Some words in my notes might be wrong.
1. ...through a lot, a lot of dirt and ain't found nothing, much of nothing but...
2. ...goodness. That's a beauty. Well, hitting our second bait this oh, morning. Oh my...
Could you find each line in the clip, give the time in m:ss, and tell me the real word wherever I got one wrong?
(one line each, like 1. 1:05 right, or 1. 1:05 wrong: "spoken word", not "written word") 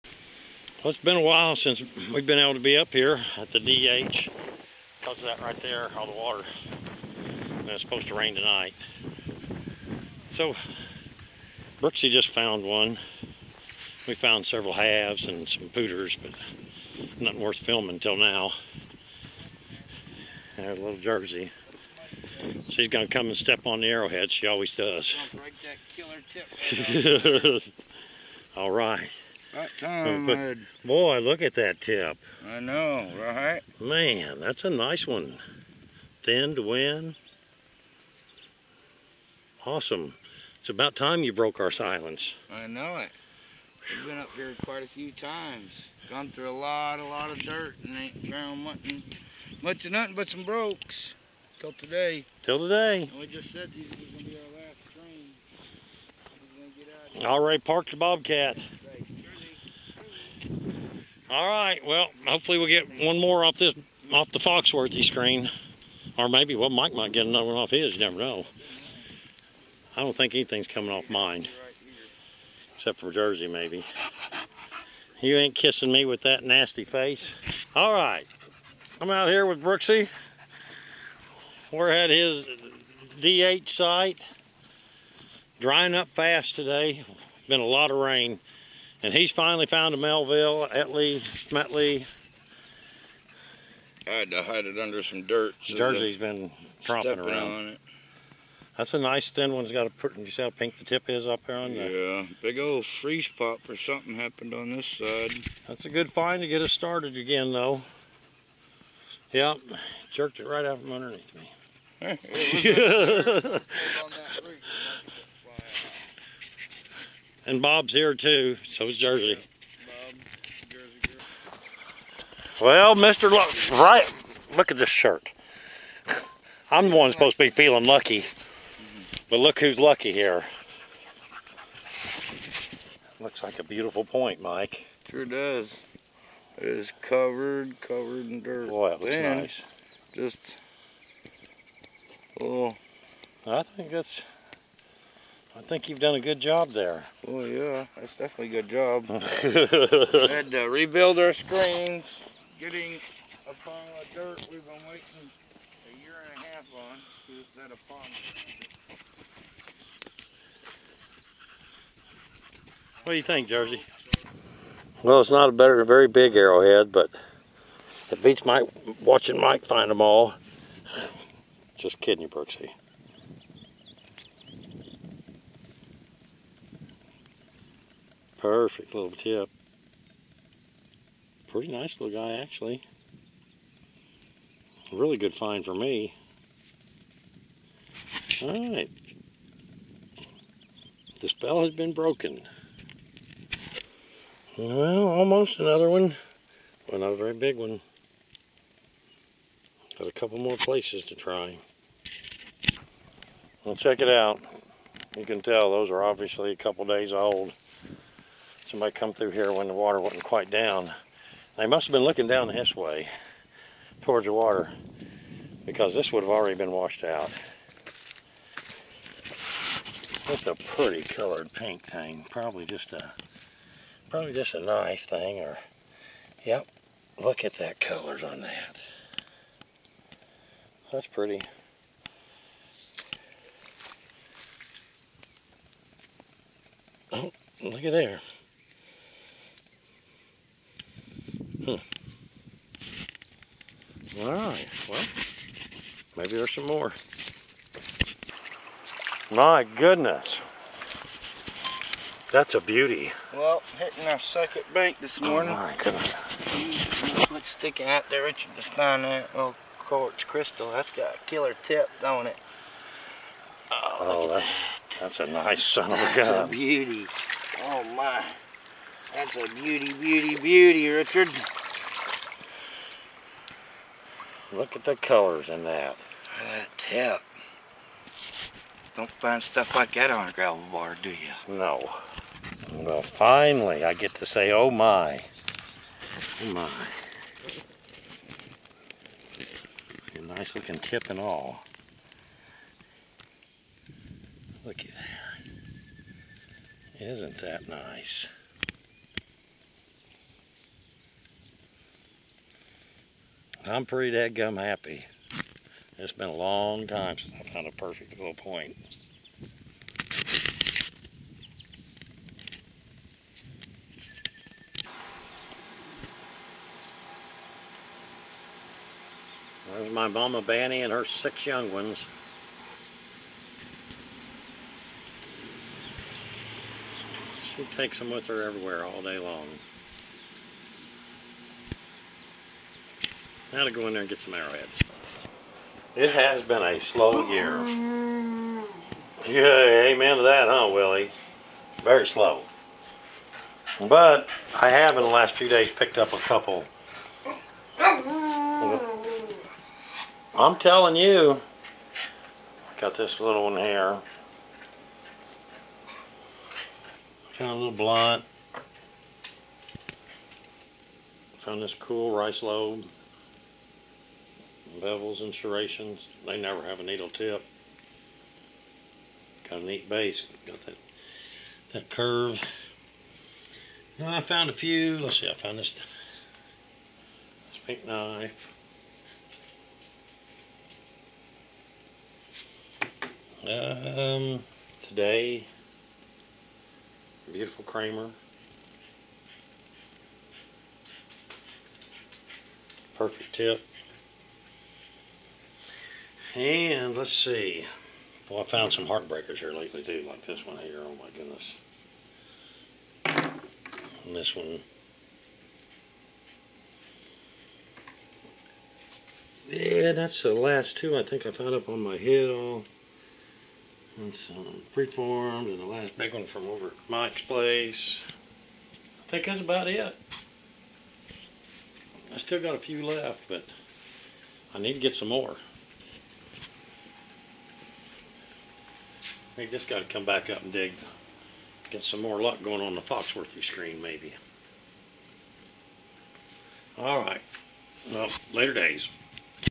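1. 0:46 right
2. 4:09 right.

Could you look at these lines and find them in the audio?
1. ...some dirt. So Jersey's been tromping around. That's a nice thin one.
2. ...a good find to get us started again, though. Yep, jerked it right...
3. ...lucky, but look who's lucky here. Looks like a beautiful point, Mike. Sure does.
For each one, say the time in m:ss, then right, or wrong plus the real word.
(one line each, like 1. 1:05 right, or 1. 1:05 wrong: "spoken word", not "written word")
1. 1:35 right
2. 1:45 right
3. 2:07 right.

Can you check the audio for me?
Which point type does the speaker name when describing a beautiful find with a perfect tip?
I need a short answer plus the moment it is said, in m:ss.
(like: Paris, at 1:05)
Kramer, at 6:27.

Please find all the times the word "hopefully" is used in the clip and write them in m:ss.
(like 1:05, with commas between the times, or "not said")
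1:02.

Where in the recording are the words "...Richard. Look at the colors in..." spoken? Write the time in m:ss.
4:30.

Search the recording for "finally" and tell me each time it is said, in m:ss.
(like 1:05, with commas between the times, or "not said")
1:29, 4:43.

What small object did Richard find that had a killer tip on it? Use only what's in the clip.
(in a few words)
quartz crystal.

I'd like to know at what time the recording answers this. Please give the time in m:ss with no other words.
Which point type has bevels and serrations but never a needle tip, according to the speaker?
6:02.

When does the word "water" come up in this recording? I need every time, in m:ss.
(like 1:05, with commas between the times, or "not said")
0:06, 3:29, 3:34.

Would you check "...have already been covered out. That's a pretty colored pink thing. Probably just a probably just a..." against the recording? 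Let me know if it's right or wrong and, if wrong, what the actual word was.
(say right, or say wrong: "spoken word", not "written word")
wrong: "washed", not "covered".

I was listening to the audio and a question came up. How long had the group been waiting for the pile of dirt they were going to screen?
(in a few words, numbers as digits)
a year and a half.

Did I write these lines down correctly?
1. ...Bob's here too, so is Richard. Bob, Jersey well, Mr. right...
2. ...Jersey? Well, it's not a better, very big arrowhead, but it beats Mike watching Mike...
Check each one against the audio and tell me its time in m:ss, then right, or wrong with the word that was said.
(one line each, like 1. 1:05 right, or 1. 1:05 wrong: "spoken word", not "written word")
1. 1:57 wrong: "Jersey", not "Richard"
2. 2:43 right.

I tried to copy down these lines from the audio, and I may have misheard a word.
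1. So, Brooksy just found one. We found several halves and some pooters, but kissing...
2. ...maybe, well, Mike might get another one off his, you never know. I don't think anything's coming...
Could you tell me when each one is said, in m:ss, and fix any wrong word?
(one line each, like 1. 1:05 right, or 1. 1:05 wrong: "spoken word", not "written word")
1. 0:10 wrong: "nothing", not "kissing"
2. 1:06 right.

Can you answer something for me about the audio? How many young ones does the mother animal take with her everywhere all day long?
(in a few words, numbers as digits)
6.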